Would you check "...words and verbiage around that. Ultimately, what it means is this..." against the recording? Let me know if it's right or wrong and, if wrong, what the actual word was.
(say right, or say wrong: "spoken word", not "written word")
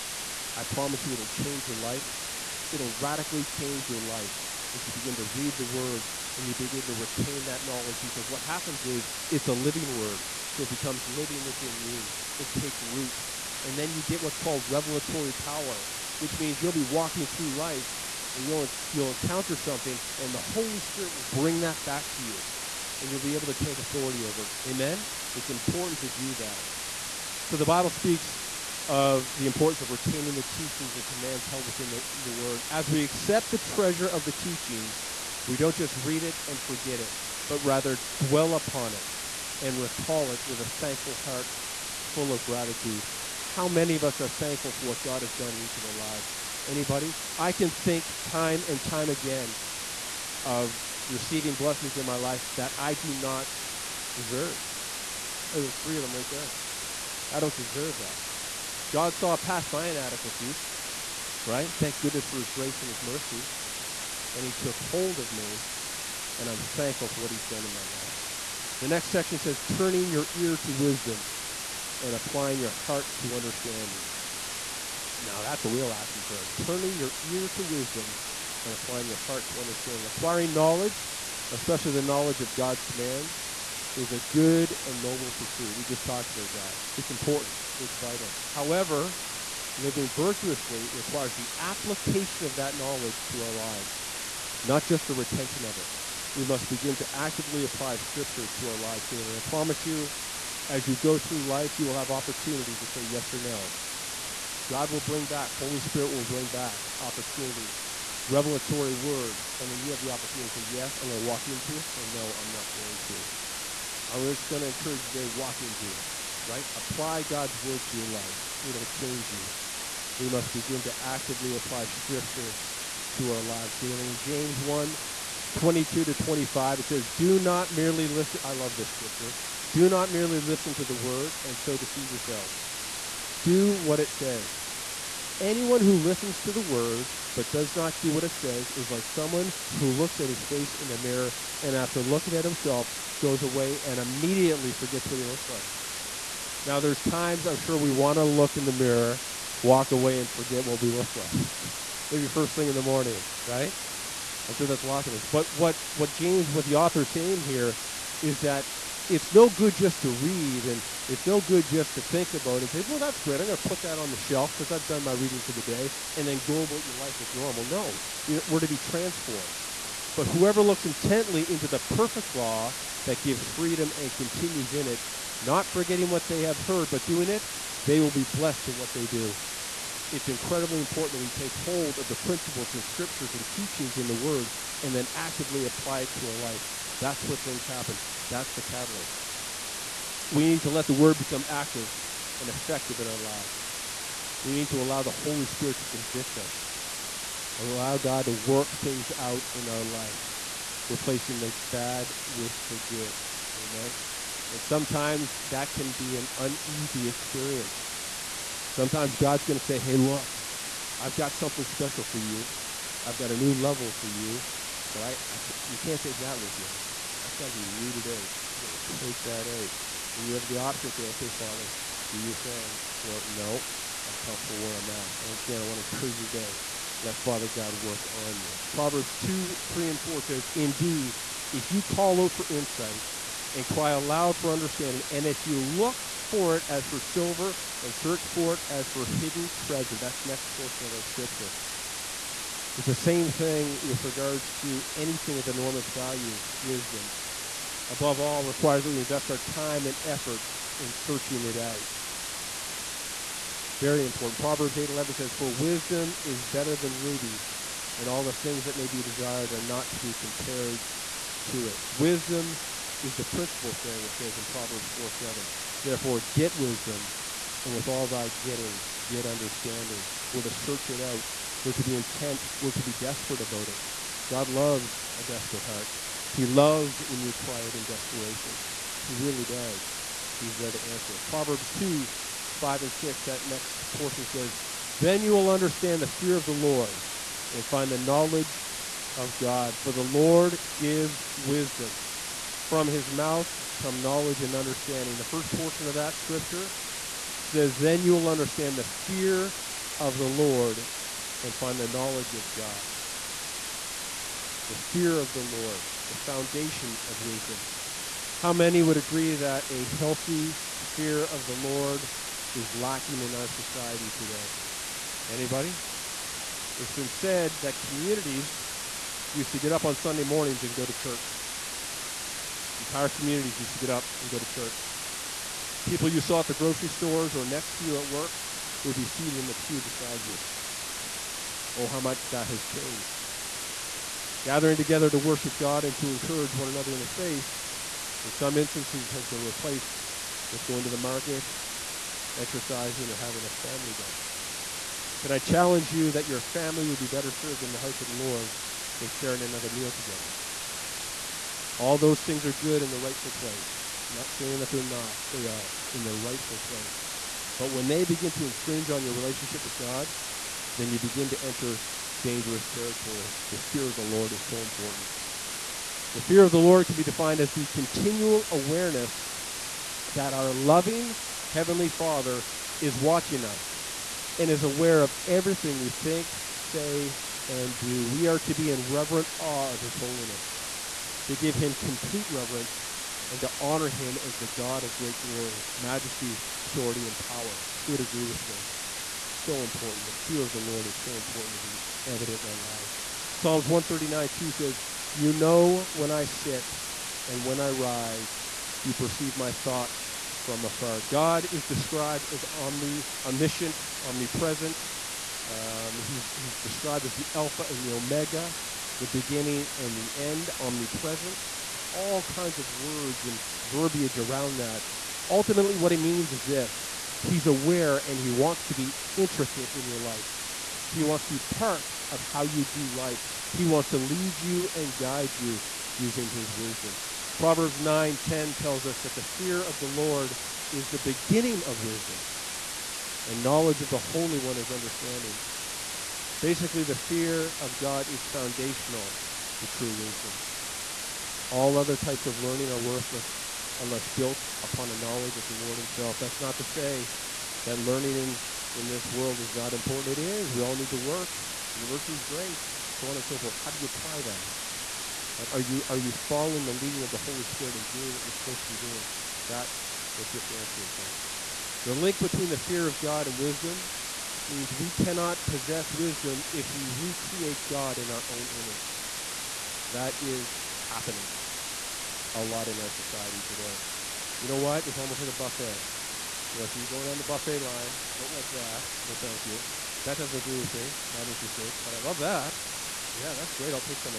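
right.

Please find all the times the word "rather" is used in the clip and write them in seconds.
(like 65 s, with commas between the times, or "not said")
37 s.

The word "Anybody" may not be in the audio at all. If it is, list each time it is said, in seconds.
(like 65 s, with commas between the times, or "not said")
46 s, 315 s.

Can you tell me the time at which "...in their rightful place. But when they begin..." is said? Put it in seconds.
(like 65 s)
355 s.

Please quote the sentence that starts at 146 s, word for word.
Now, there's times I'm sure we want to look in the mirror, walk away, and forget what we look like.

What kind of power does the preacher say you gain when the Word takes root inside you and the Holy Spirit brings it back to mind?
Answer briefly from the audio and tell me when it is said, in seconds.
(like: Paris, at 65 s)
revelatory power, at 14 s.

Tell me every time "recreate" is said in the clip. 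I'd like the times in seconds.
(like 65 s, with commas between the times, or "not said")
466 s.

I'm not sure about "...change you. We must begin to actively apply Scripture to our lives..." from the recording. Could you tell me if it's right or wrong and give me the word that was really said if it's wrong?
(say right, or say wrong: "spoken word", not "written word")
right.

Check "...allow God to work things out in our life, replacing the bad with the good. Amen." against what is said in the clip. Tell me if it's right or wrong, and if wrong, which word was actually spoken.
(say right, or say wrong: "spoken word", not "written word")
right.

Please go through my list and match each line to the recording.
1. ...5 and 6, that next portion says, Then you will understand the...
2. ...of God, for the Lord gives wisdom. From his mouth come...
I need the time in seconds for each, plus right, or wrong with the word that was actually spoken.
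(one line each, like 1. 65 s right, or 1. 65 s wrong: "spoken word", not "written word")
1. 282 s right
2. 289 s right.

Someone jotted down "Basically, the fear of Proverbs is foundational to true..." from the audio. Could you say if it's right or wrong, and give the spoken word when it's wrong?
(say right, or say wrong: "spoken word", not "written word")
wrong: "God", not "Proverbs".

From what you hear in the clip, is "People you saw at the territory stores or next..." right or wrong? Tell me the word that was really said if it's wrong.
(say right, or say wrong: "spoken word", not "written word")
wrong: "grocery", not "territory".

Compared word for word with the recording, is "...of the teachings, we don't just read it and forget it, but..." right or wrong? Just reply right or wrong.
right.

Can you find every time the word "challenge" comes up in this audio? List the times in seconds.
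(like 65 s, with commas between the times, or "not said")
345 s.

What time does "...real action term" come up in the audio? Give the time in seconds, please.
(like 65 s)
75 s.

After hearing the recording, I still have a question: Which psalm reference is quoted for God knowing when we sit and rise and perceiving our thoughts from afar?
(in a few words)
Psalms 139:2.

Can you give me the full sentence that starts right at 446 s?
That's not to say that learning in, in this world is not important.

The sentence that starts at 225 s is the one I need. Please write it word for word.
Well, again, I want to encourage you today.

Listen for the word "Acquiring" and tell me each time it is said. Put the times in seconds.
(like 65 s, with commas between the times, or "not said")
80 s.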